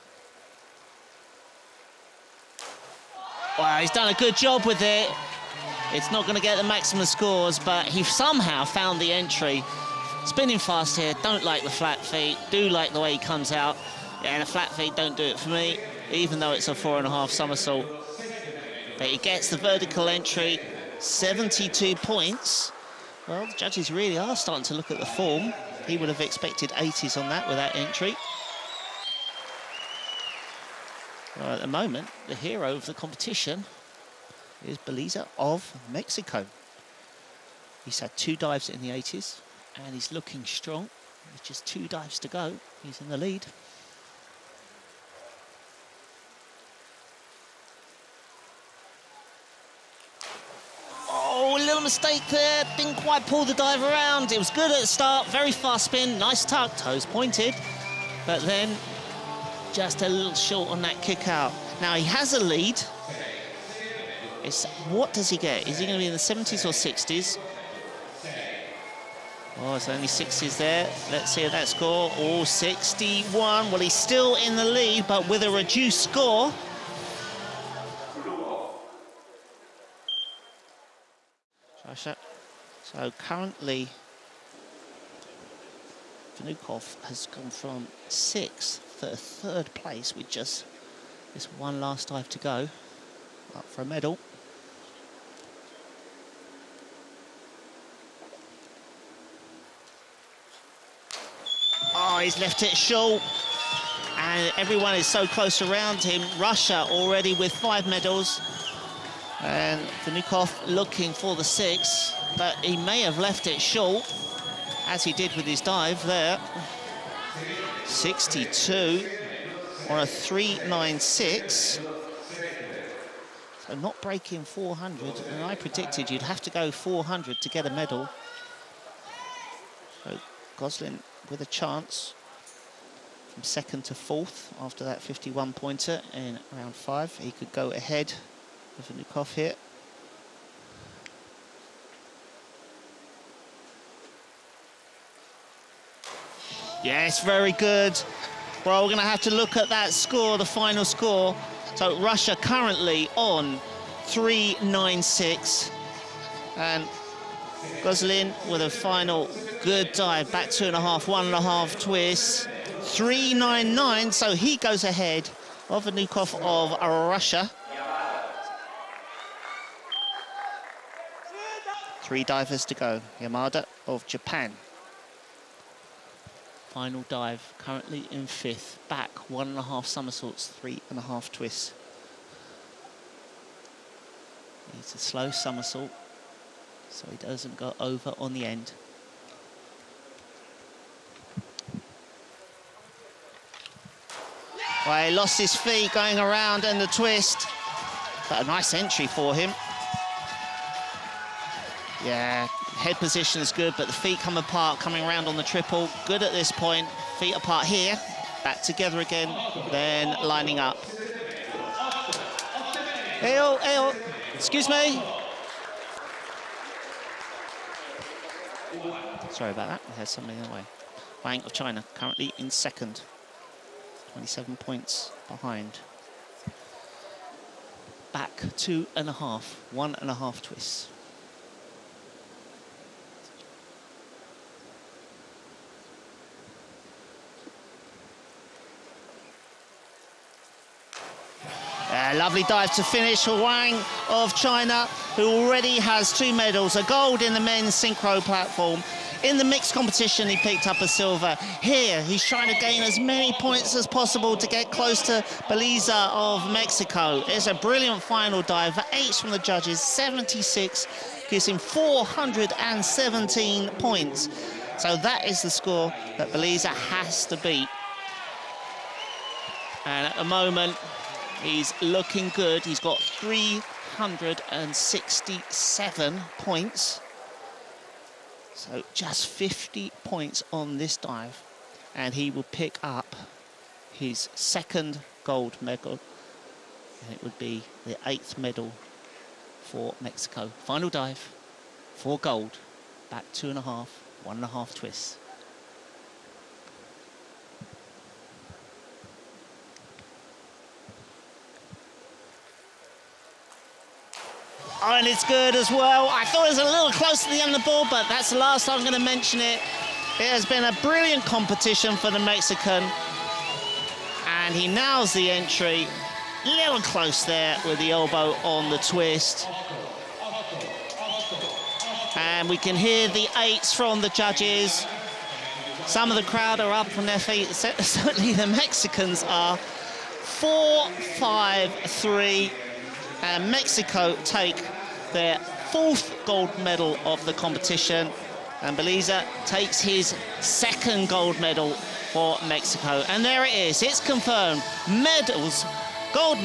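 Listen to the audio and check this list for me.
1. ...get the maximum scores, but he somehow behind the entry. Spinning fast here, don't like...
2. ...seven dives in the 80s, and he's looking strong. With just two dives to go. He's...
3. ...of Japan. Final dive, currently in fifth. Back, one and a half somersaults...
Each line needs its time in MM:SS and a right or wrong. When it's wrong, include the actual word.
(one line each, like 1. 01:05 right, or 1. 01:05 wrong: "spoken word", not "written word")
1. 00:06 wrong: "found", not "behind"
2. 00:38 wrong: "two", not "seven"
3. 02:53 right.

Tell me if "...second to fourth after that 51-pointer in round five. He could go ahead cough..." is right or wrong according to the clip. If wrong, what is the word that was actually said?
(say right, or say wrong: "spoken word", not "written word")
right.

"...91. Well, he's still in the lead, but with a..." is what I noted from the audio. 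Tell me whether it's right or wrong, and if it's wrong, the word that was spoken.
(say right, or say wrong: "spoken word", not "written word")
wrong: "61", not "91".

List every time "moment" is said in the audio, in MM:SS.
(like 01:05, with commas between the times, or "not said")
00:31, 04:30.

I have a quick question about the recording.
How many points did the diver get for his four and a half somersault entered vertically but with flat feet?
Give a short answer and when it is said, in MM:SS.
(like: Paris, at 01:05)
72, at 00:20.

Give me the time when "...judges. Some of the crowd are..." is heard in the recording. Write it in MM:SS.
05:24.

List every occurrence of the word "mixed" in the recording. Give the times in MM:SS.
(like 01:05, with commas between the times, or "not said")
04:09.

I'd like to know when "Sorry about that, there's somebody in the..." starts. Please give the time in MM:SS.
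03:39.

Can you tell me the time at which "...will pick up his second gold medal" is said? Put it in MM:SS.
04:42.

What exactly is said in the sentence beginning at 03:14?
Well, he lost his feet going around and the twist.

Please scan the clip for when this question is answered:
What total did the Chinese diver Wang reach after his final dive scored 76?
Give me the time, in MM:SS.
04:21.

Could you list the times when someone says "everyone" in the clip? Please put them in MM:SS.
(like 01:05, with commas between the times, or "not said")
01:44.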